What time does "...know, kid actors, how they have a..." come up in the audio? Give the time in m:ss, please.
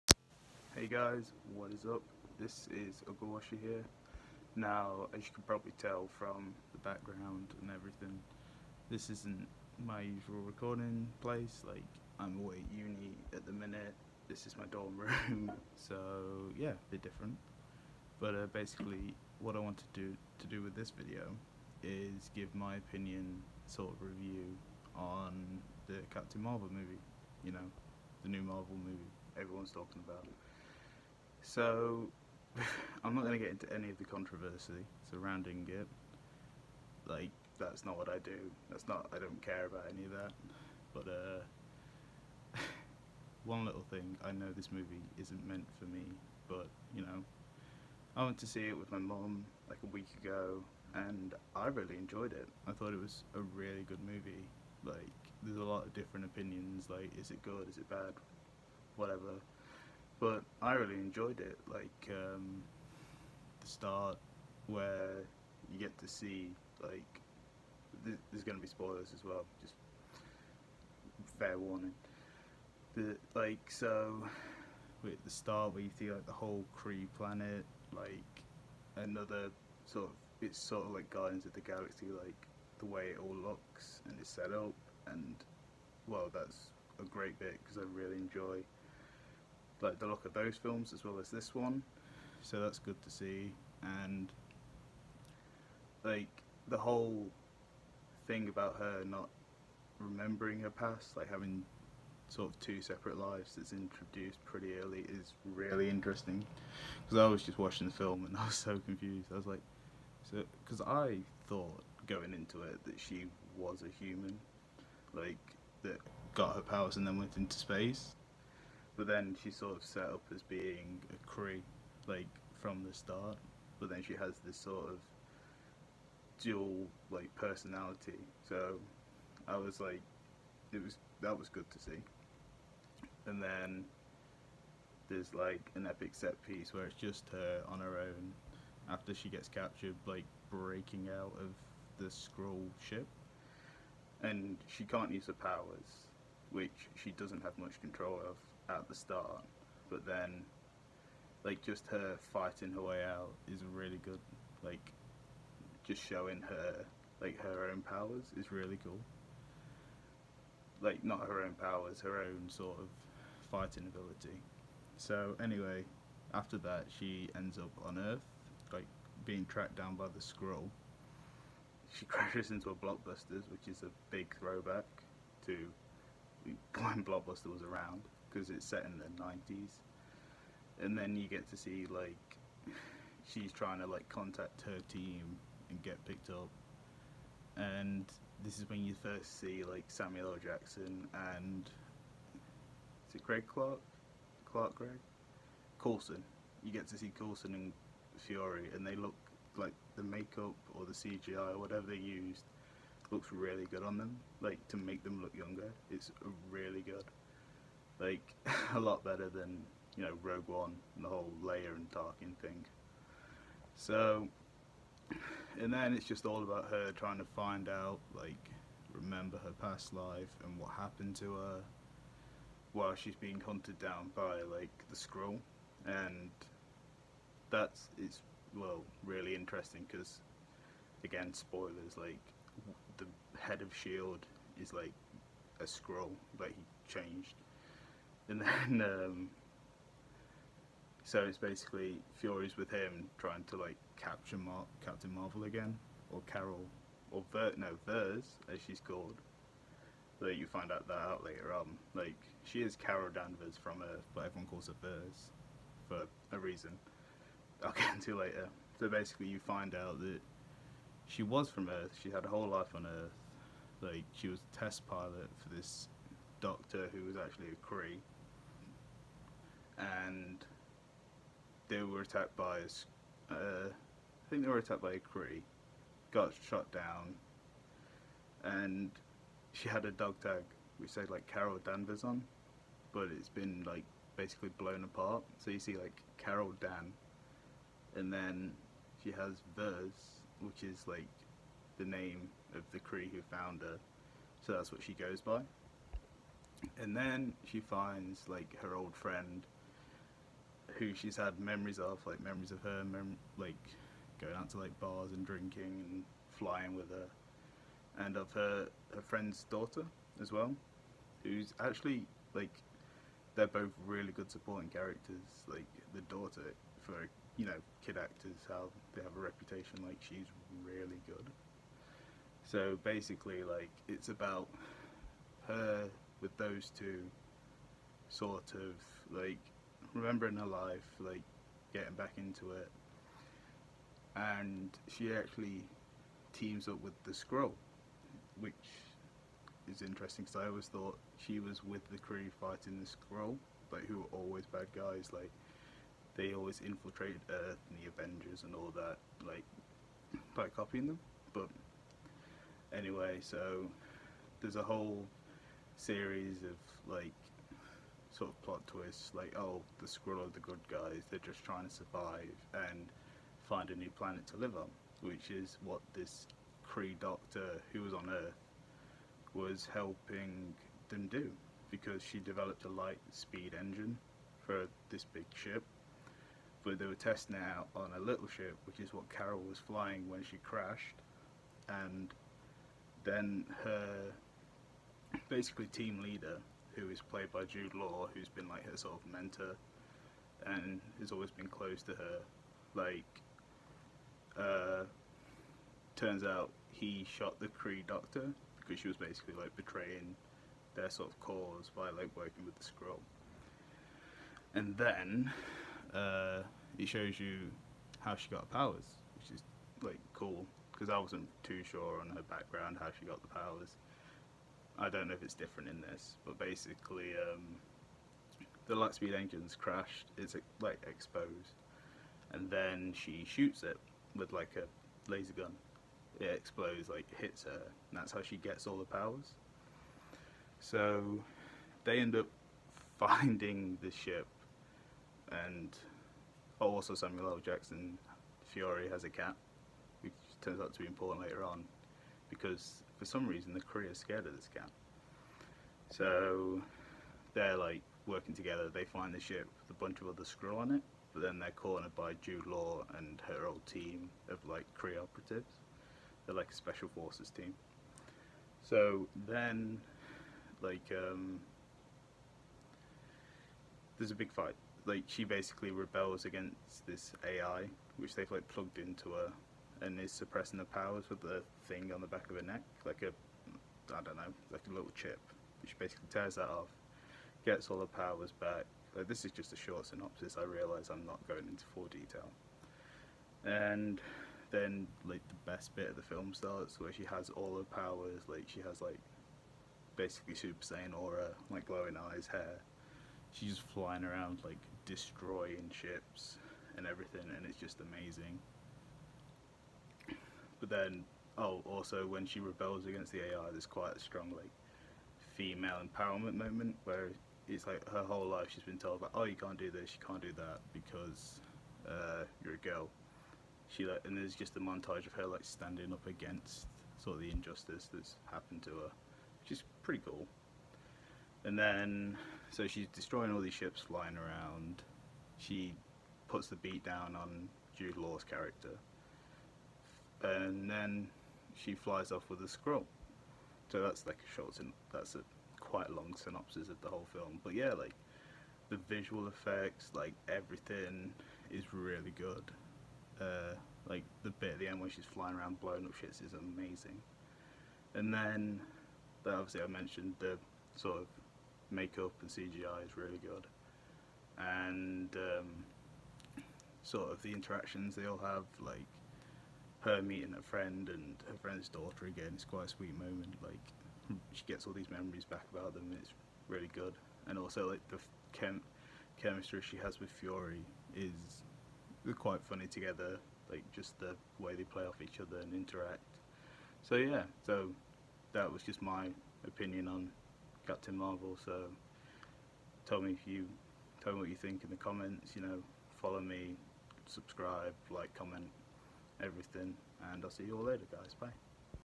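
5:17.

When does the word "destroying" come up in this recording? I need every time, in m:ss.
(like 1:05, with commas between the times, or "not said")
8:14, 8:42.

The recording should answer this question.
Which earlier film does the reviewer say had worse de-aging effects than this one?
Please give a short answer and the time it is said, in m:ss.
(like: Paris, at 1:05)
Rogue One, at 3:30.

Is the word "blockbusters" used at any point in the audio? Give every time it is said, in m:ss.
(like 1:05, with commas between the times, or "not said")
2:52, 2:57.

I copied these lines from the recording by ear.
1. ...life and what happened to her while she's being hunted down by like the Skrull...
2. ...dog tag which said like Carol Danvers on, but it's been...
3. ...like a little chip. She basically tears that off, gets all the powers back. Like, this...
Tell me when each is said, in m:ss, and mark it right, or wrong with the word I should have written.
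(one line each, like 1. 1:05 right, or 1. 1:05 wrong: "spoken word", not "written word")
1. 3:39 right
2. 4:39 right
3. 7:54 right.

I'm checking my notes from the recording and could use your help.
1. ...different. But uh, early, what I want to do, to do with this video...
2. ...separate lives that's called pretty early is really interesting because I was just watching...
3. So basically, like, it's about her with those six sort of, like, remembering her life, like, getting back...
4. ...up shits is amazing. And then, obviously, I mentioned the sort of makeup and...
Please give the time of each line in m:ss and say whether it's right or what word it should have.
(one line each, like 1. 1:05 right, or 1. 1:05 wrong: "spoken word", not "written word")
1. 0:17 wrong: "basically", not "early"
2. 1:42 wrong: "introduced", not "called"
3. 5:22 wrong: "two", not "six"
4. 9:05 right.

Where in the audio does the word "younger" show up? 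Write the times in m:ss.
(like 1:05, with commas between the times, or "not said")
3:25.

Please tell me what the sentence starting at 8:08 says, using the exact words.
Like she has like basically Super Saiyan aura, like glowing eyes, hair.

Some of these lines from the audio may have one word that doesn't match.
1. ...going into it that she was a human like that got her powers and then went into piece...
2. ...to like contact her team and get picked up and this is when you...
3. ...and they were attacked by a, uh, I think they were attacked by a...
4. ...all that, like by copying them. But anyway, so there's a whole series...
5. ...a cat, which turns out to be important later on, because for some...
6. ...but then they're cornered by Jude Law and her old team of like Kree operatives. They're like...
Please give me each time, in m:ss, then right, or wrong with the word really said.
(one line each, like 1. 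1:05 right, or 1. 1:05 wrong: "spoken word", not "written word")
1. 1:52 wrong: "space", not "piece"
2. 3:03 right
3. 4:29 right
4. 5:48 right
5. 7:19 right
6. 7:31 right.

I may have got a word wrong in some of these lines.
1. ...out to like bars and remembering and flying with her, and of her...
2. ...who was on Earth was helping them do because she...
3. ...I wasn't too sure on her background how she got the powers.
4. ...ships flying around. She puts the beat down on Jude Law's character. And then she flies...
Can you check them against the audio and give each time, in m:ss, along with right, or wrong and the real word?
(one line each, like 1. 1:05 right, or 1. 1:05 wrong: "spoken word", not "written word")
1. 5:04 wrong: "drinking", not "remembering"
2. 6:07 right
3. 6:50 right
4. 8:43 right.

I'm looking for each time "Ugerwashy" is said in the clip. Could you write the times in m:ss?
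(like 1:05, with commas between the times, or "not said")
0:03.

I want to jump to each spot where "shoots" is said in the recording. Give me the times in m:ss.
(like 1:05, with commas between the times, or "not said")
7:03.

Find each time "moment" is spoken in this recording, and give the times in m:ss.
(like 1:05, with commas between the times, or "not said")
8:26, 9:22.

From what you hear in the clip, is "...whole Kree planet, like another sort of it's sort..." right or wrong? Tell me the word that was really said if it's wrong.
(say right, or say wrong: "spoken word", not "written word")
right.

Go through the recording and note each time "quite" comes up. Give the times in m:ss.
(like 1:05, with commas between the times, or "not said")
8:23, 8:55, 9:22, 9:32.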